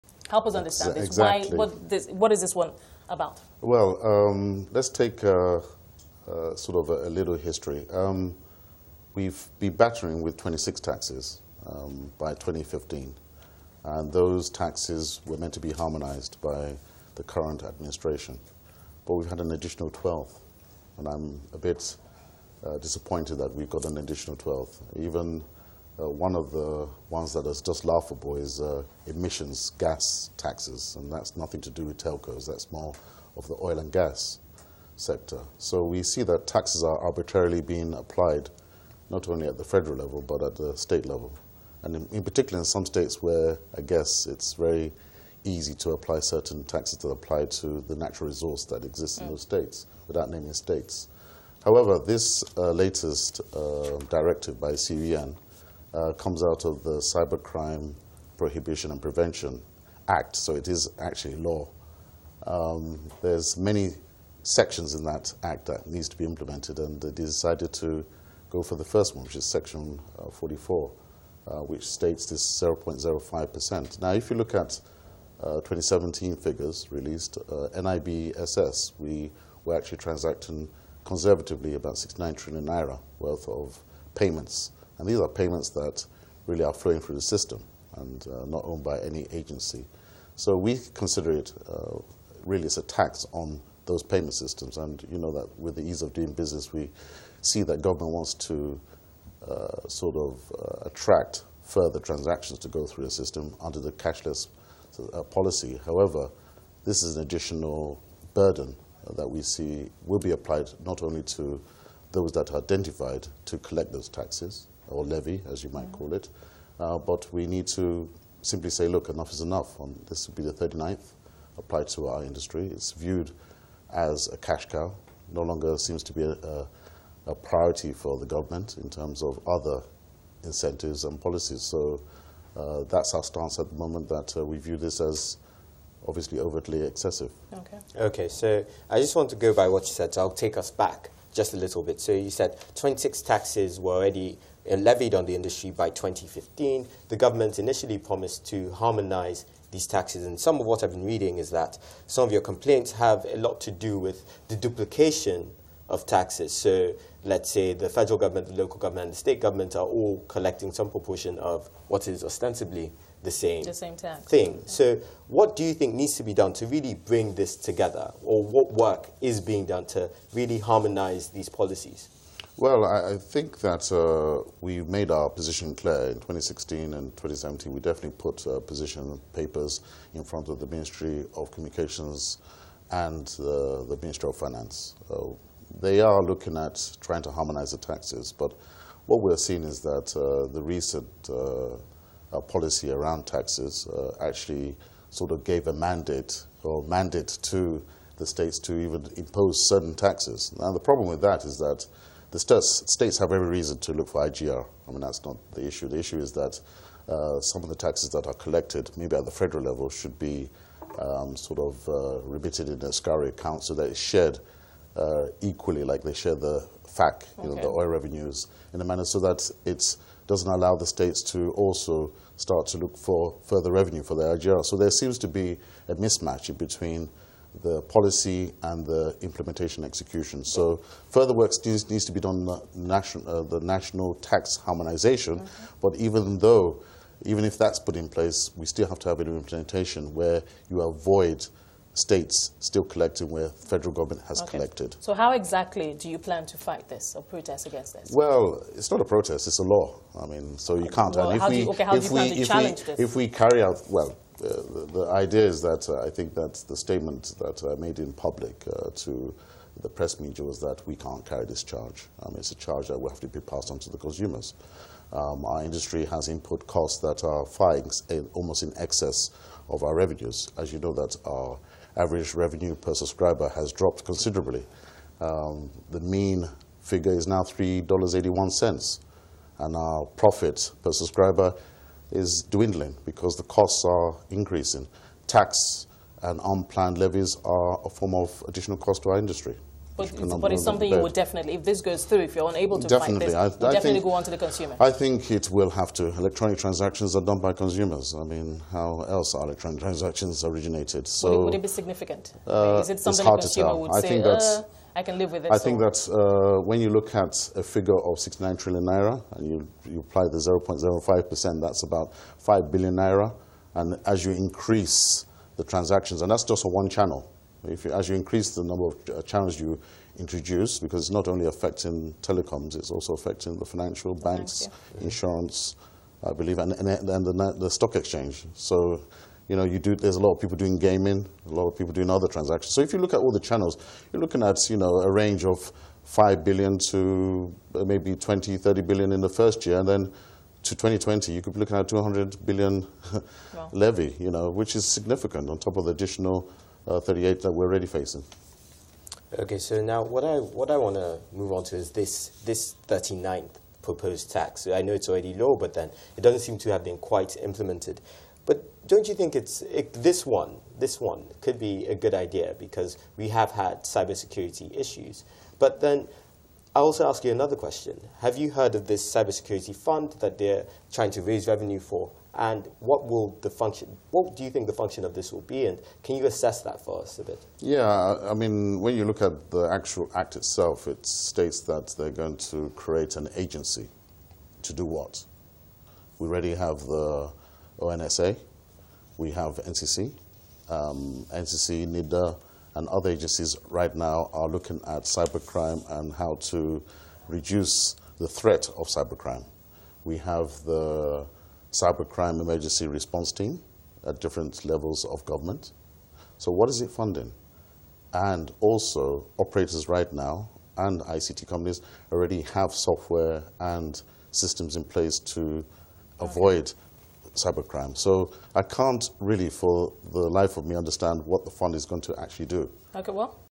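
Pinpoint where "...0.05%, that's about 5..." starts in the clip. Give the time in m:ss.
5:10.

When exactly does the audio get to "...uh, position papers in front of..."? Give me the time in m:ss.
2:58.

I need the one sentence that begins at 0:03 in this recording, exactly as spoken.
Well, um, let's take uh, uh, sort of a, a little history.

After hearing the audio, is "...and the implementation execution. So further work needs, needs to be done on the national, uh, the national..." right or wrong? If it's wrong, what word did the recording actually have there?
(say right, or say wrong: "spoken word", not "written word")
right.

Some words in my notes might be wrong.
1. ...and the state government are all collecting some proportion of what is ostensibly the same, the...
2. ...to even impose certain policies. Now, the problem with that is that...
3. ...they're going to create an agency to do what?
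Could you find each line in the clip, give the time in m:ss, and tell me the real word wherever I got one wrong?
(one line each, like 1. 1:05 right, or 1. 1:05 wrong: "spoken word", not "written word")
1. 2:39 right
2. 3:18 wrong: "taxes", not "policies"
3. 6:21 right.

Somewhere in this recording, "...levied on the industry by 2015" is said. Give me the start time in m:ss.
2:24.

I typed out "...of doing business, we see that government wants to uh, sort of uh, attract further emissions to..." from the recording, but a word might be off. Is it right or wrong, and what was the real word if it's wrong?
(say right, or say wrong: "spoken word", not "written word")
wrong: "transactions", not "emissions".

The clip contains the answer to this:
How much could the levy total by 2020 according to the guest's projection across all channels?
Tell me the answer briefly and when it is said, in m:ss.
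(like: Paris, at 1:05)
200 billion, at 5:41.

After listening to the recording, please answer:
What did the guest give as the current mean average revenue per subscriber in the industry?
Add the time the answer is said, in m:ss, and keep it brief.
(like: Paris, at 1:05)
$3.81, at 4:37.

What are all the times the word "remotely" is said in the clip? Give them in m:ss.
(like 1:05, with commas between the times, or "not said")
not said.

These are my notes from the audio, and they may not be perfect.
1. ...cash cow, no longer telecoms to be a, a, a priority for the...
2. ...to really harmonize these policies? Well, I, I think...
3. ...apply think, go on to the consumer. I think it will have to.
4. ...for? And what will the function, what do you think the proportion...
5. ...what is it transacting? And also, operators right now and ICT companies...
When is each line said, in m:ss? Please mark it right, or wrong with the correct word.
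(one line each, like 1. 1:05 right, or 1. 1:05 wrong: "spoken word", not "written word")
1. 2:04 wrong: "seems", not "telecoms"
2. 2:49 right
3. 4:53 wrong: "definitely", not "apply"
4. 6:11 wrong: "function", not "proportion"
5. 6:46 wrong: "funding", not "transacting".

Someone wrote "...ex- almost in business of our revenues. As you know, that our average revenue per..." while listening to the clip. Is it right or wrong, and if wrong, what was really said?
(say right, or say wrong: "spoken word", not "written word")
wrong: "excess", not "business".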